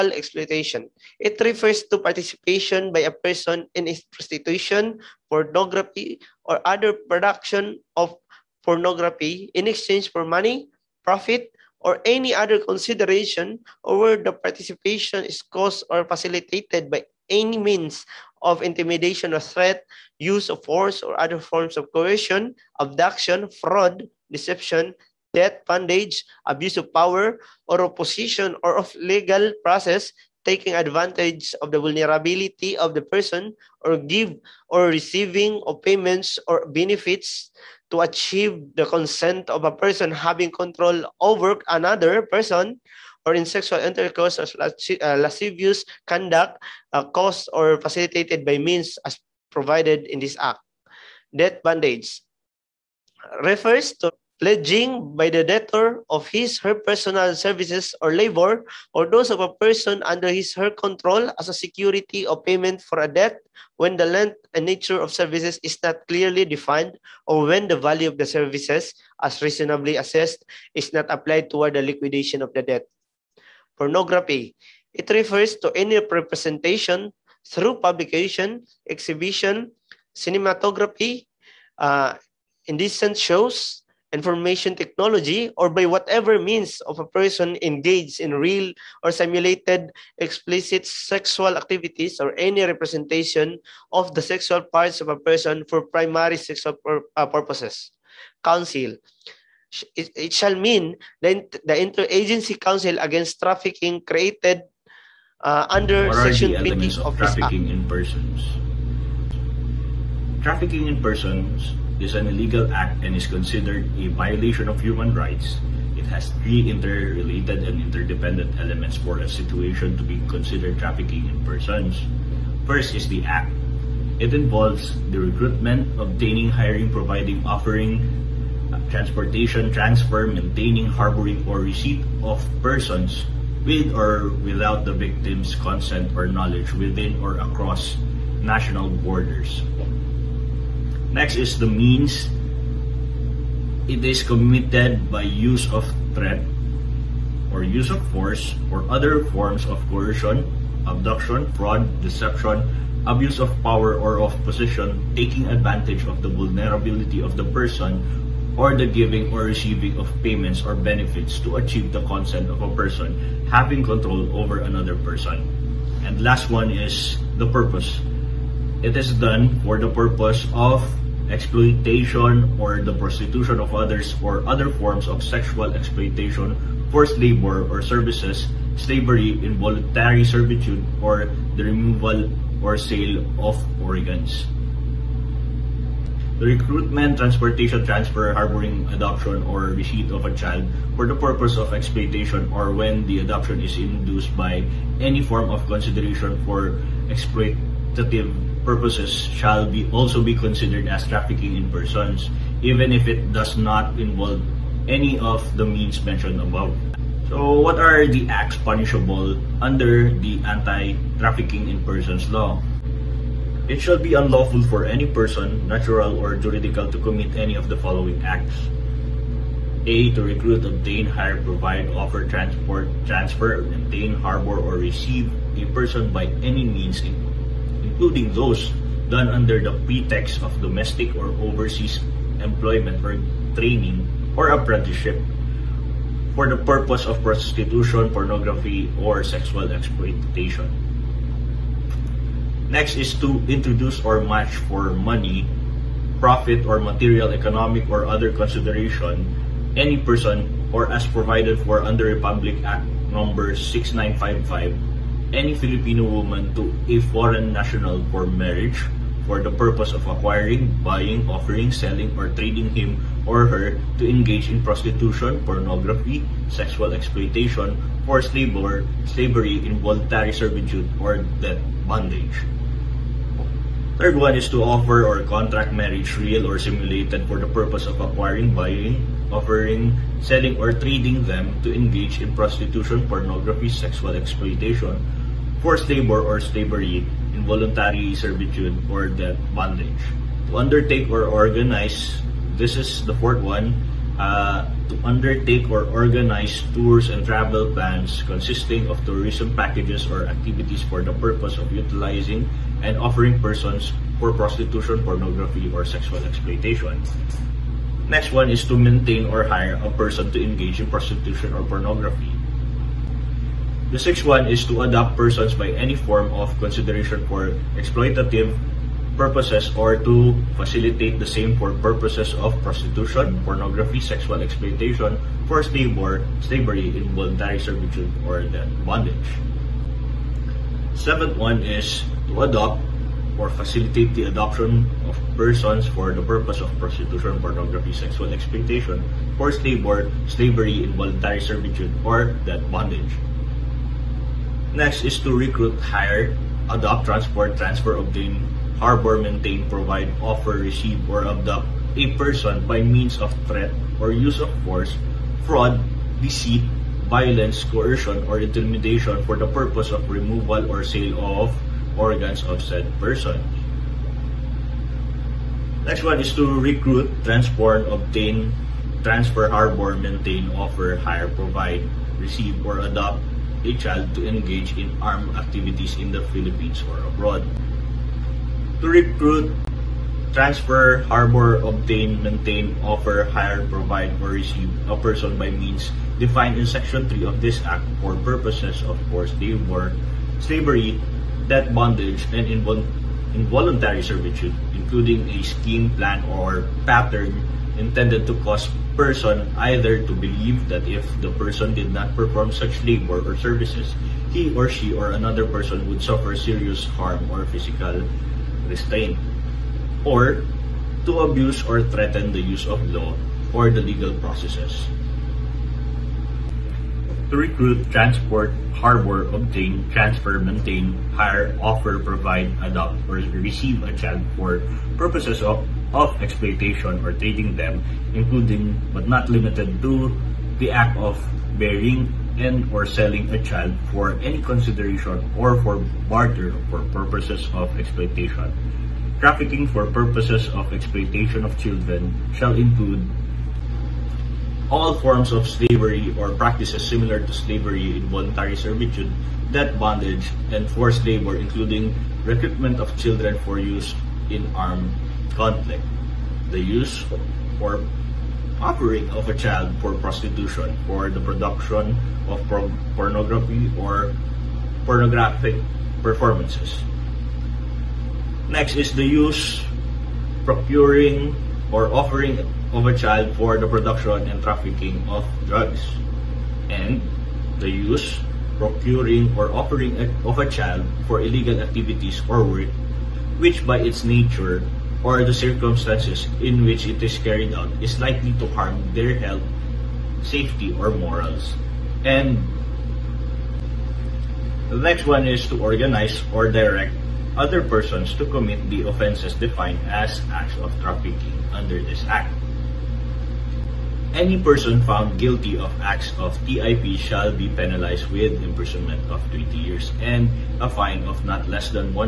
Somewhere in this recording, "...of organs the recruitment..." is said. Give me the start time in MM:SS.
03:03.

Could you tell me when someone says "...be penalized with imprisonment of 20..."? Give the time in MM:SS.
08:27.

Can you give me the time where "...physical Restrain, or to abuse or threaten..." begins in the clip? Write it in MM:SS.
06:47.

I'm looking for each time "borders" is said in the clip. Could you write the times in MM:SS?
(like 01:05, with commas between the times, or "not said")
02:18.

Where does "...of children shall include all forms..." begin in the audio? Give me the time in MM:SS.
07:21.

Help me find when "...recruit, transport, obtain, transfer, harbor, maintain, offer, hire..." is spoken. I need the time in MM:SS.
06:06.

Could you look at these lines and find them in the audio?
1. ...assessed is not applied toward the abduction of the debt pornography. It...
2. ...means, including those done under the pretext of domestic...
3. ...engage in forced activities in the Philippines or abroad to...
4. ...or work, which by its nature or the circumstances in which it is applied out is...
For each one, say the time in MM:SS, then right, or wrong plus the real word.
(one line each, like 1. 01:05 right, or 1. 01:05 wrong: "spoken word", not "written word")
1. 01:10 wrong: "liquidation", not "abduction"
2. 03:46 right
3. 06:14 wrong: "armed", not "forced"
4. 08:02 wrong: "carried", not "applied".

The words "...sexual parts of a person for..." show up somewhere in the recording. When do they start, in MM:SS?
01:34.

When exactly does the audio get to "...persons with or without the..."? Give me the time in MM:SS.
02:12.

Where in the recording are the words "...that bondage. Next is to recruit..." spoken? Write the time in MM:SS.
05:42.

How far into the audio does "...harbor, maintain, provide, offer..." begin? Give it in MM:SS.
05:48.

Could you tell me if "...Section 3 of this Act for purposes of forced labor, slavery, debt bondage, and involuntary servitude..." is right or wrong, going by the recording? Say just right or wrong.
right.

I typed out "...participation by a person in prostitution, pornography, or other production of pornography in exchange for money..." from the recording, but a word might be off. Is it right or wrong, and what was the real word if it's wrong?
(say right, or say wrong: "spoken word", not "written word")
right.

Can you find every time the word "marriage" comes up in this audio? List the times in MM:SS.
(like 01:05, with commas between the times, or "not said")
04:18, 04:35.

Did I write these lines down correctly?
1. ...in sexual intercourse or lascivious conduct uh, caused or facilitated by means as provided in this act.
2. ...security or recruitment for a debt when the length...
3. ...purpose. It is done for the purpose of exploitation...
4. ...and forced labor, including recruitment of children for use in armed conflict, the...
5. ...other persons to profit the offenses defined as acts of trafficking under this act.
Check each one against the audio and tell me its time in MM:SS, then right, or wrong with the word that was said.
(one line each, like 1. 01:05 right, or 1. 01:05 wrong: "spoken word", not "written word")
1. 00:43 right
2. 01:01 wrong: "payment", not "recruitment"
3. 02:47 right
4. 07:30 right
5. 08:17 wrong: "commit", not "profit".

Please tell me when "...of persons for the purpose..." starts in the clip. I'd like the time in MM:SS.
05:35.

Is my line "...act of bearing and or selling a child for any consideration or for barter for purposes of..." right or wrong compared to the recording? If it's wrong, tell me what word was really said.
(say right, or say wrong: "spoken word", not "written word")
right.